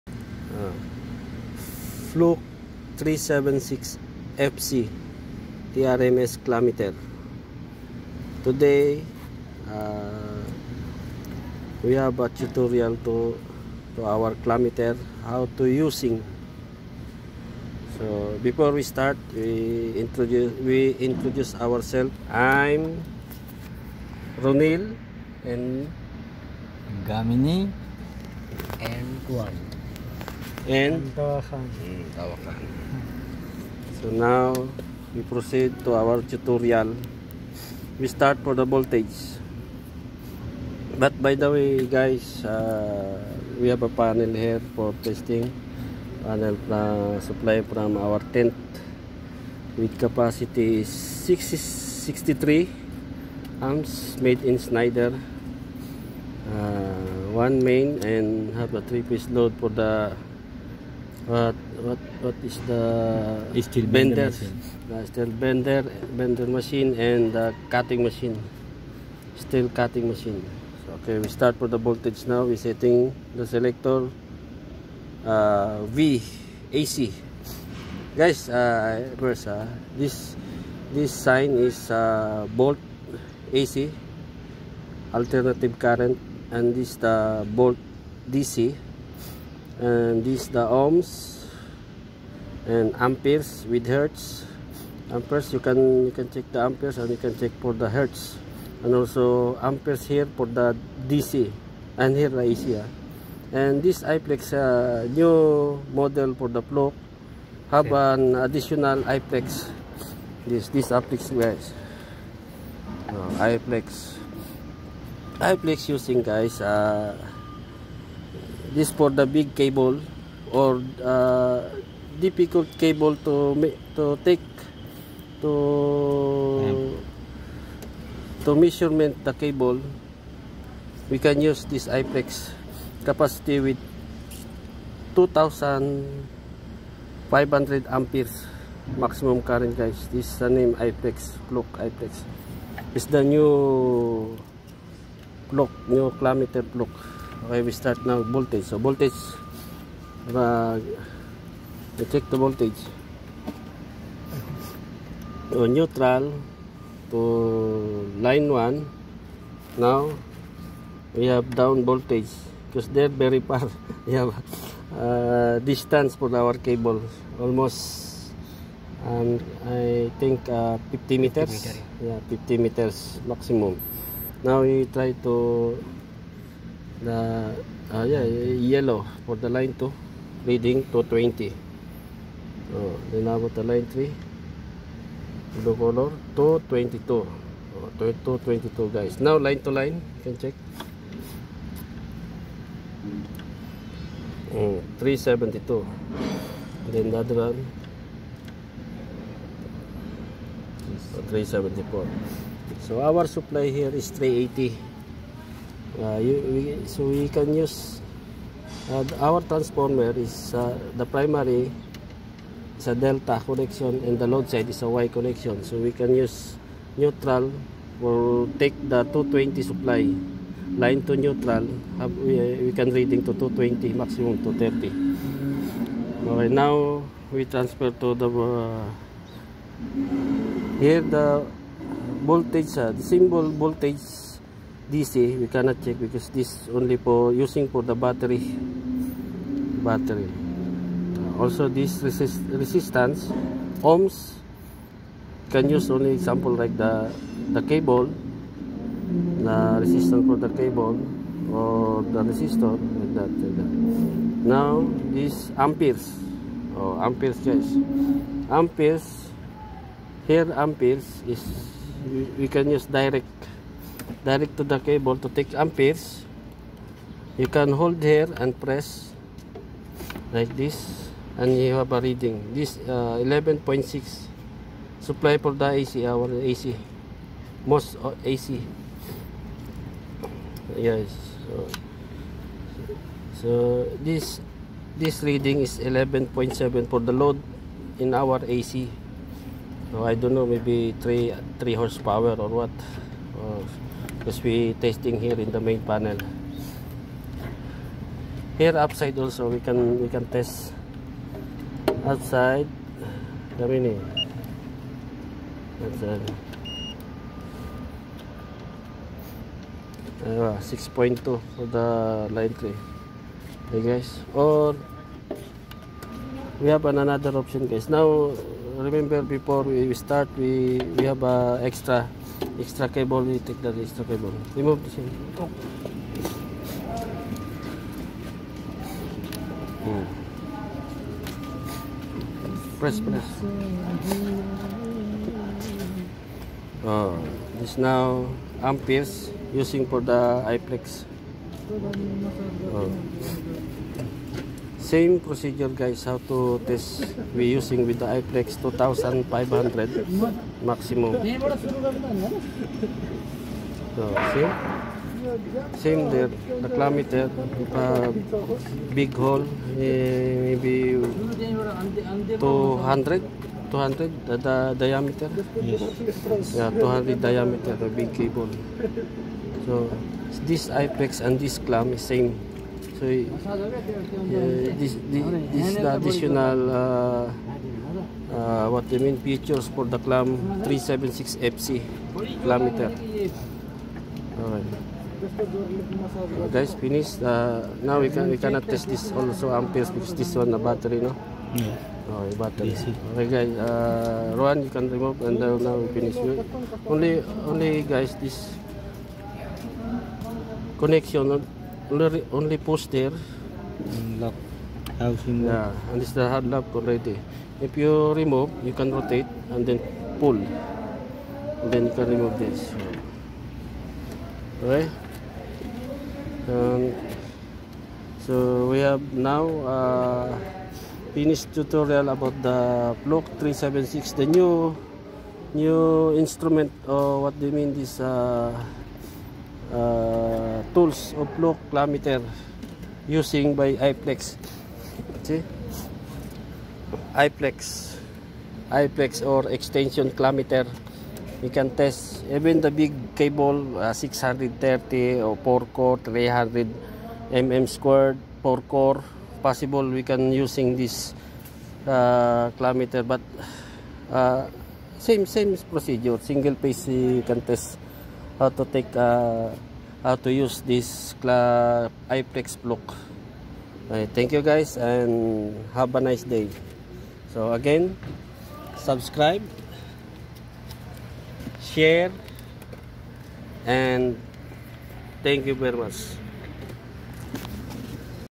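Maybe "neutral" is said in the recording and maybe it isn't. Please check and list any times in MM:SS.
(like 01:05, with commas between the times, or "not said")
02:35, 03:36, 03:41.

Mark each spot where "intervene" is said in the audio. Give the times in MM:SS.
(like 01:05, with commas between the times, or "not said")
not said.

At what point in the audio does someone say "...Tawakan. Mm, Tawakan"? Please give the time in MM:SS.
00:31.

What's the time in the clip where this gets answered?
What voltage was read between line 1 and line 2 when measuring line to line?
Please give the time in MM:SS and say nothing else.
03:15.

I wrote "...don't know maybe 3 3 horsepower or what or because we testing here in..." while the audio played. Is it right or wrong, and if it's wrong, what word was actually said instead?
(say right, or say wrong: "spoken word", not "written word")
right.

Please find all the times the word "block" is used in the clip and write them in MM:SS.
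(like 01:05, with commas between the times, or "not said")
07:03, 07:42.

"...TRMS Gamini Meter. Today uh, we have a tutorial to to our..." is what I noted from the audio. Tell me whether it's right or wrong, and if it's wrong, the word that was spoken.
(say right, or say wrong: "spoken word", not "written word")
wrong: "Clamp", not "Gamini".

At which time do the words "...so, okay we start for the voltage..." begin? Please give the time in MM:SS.
01:10.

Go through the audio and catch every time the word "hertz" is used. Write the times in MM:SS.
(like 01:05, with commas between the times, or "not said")
01:33, 01:37.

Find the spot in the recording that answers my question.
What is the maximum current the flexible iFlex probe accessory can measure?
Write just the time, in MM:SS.
02:15.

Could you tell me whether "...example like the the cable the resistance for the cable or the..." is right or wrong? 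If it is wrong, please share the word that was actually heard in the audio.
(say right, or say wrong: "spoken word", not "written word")
right.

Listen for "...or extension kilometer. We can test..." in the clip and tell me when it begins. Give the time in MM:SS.
07:19.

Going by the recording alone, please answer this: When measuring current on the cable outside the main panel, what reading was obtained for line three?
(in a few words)
6.2.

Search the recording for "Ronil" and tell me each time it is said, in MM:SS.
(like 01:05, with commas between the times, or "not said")
00:24.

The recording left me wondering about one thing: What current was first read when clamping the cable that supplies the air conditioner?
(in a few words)
11.6.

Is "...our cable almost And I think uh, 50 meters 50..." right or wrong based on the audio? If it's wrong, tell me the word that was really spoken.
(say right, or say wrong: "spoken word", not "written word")
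right.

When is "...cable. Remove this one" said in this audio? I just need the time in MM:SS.
05:24.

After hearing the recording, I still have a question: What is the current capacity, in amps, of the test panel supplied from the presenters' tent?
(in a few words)
63.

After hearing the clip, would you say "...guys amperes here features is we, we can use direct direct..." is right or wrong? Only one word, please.
wrong.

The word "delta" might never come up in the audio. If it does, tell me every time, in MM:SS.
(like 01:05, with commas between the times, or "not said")
03:32.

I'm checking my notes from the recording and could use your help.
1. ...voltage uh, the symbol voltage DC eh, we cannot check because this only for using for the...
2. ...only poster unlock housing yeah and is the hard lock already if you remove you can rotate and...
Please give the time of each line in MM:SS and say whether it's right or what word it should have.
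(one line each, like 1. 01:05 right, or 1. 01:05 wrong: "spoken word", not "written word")
1. 03:52 right
2. 06:42 right.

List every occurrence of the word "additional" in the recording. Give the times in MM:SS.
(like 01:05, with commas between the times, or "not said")
01:48, 06:15.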